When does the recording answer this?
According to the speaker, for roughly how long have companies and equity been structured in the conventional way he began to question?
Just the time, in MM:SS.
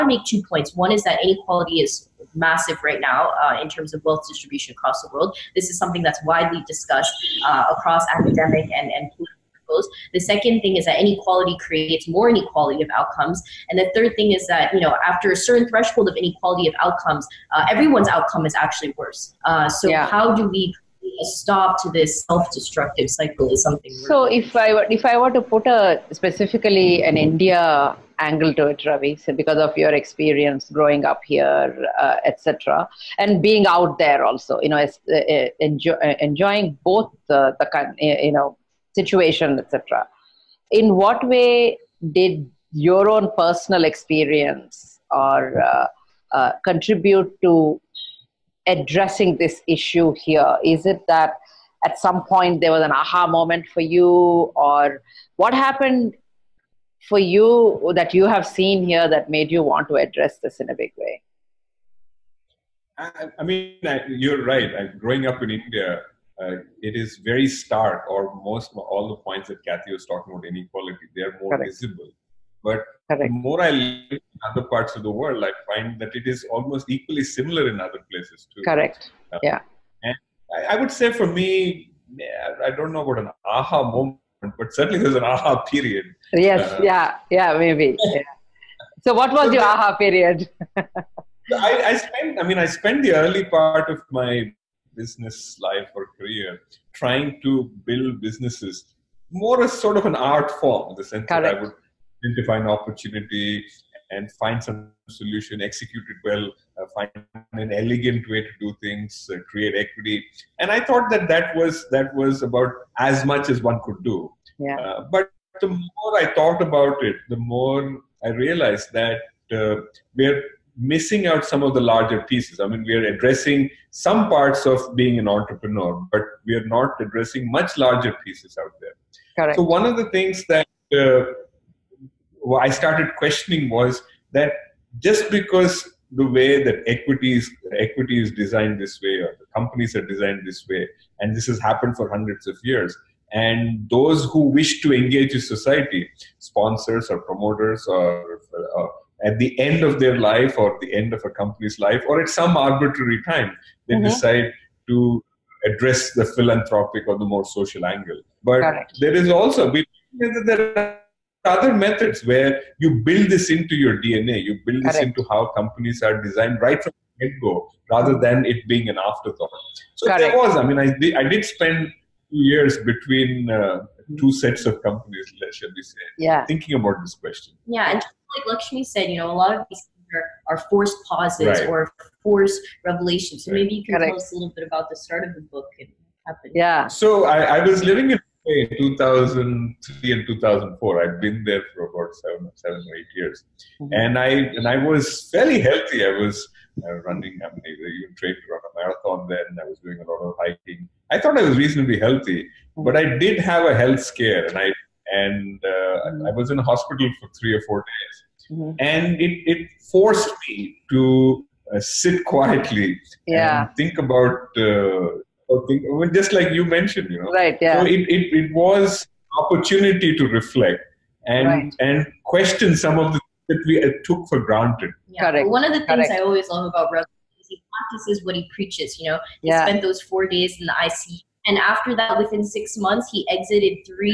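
02:22.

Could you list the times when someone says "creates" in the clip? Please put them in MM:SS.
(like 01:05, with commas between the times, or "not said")
00:11, 01:49.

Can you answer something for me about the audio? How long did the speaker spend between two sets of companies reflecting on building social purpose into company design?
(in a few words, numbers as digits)
2 years.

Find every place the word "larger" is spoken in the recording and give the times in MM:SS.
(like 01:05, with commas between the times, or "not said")
02:01, 02:07.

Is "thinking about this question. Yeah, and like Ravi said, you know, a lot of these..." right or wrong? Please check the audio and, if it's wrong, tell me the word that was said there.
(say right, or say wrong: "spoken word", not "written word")
wrong: "Lakshmi", not "Ravi".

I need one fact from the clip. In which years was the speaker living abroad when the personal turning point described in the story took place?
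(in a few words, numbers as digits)
2003 and 2004.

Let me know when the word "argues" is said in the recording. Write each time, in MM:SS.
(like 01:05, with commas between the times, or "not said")
not said.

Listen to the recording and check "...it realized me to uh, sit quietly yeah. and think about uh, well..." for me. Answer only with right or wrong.
wrong.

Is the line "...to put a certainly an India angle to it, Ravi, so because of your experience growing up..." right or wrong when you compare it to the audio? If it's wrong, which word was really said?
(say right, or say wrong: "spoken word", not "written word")
wrong: "specifically", not "certainly".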